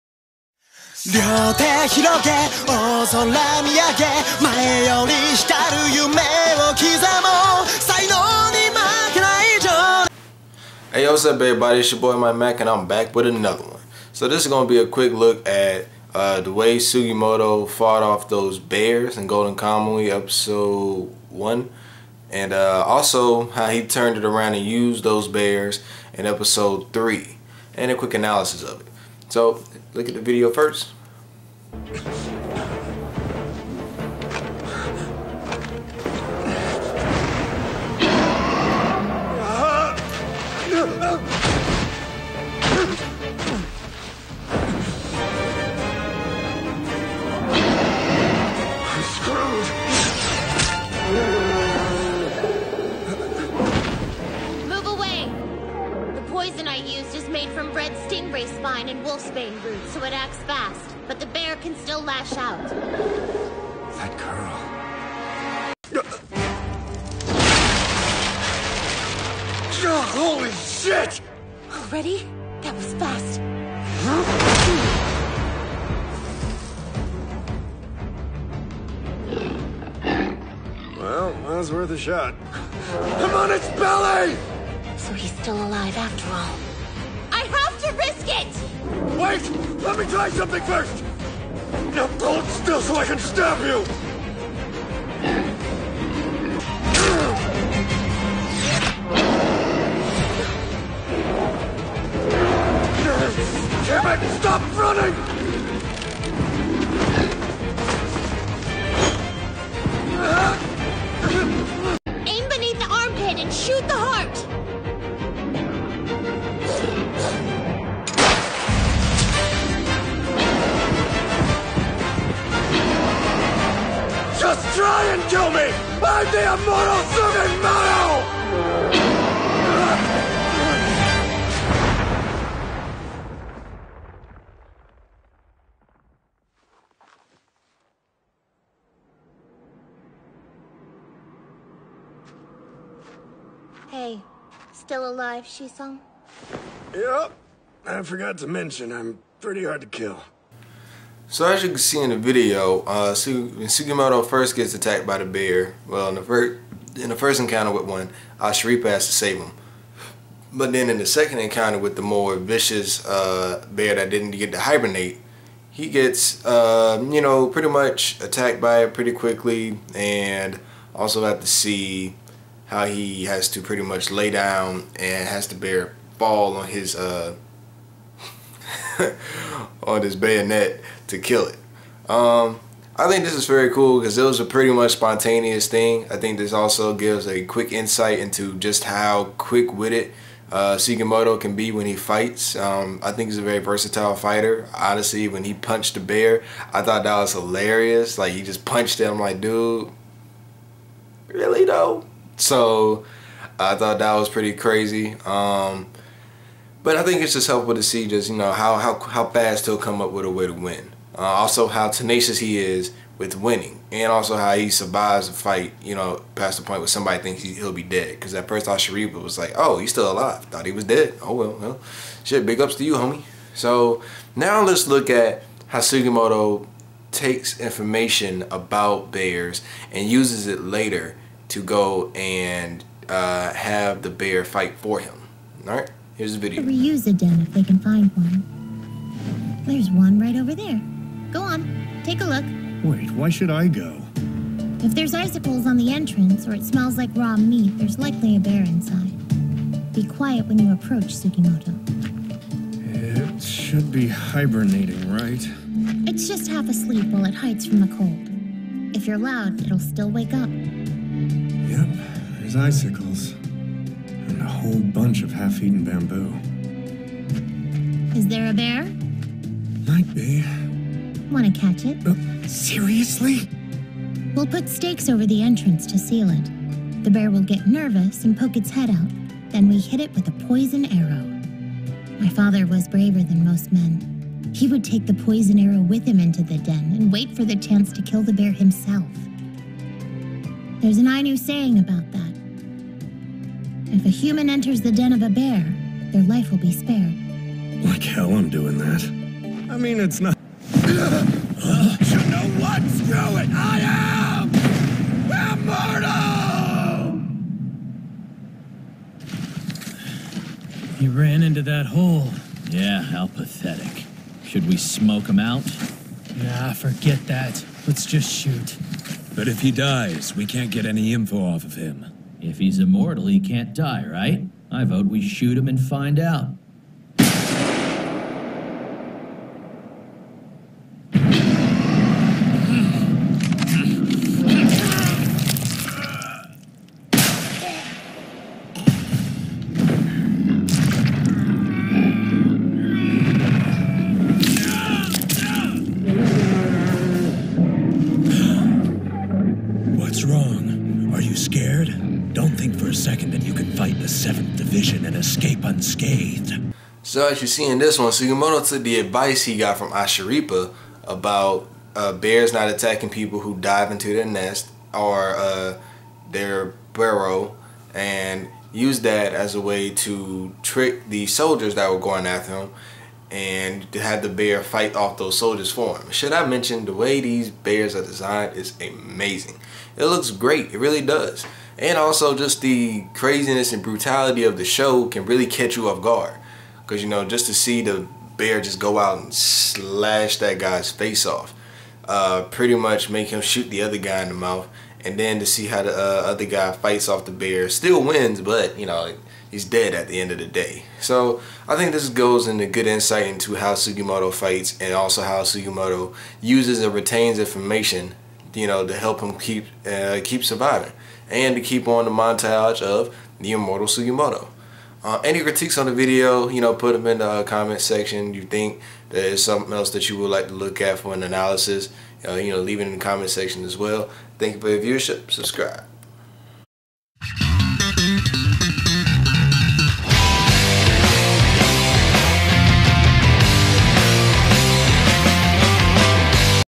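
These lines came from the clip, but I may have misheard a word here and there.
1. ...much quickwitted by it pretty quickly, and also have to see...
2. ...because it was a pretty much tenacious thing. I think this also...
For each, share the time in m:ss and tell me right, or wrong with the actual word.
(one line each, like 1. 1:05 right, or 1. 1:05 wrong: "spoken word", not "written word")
1. 2:47 wrong: "attacked", not "quickwitted"
2. 3:03 wrong: "spontaneous", not "tenacious".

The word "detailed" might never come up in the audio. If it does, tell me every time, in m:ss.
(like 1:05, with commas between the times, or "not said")
not said.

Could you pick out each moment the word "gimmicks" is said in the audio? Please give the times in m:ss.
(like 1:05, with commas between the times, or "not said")
not said.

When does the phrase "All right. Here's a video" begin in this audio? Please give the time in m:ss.
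3:55.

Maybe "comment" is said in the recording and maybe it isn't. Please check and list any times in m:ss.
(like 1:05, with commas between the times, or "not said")
6:57, 7:02.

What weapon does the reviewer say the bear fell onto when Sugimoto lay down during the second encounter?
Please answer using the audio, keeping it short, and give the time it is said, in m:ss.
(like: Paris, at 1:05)
bayonet, at 3:00.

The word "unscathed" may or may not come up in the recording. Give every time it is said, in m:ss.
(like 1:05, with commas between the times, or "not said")
5:55.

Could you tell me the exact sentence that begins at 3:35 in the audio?
You know, past the point where somebody thinks he, will be dead.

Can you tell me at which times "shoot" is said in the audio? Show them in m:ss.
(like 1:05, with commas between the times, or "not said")
5:18, 5:25, 6:33.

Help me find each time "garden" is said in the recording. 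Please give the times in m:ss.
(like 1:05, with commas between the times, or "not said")
not said.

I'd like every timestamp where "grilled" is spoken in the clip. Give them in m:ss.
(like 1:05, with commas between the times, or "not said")
not said.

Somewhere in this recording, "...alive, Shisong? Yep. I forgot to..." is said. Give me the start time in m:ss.
2:25.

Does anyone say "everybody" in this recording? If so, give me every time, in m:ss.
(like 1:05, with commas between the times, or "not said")
0:11.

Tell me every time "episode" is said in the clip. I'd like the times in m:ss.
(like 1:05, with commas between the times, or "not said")
0:20, 0:26.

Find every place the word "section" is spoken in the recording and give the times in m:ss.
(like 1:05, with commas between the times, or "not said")
6:57, 7:03.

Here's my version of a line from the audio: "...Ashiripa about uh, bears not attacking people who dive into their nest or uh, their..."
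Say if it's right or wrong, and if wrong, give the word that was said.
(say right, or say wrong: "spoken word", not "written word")
right.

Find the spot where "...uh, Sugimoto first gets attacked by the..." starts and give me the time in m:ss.
2:32.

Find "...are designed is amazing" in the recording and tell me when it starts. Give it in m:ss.
6:17.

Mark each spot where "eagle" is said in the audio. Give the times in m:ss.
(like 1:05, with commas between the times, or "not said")
not said.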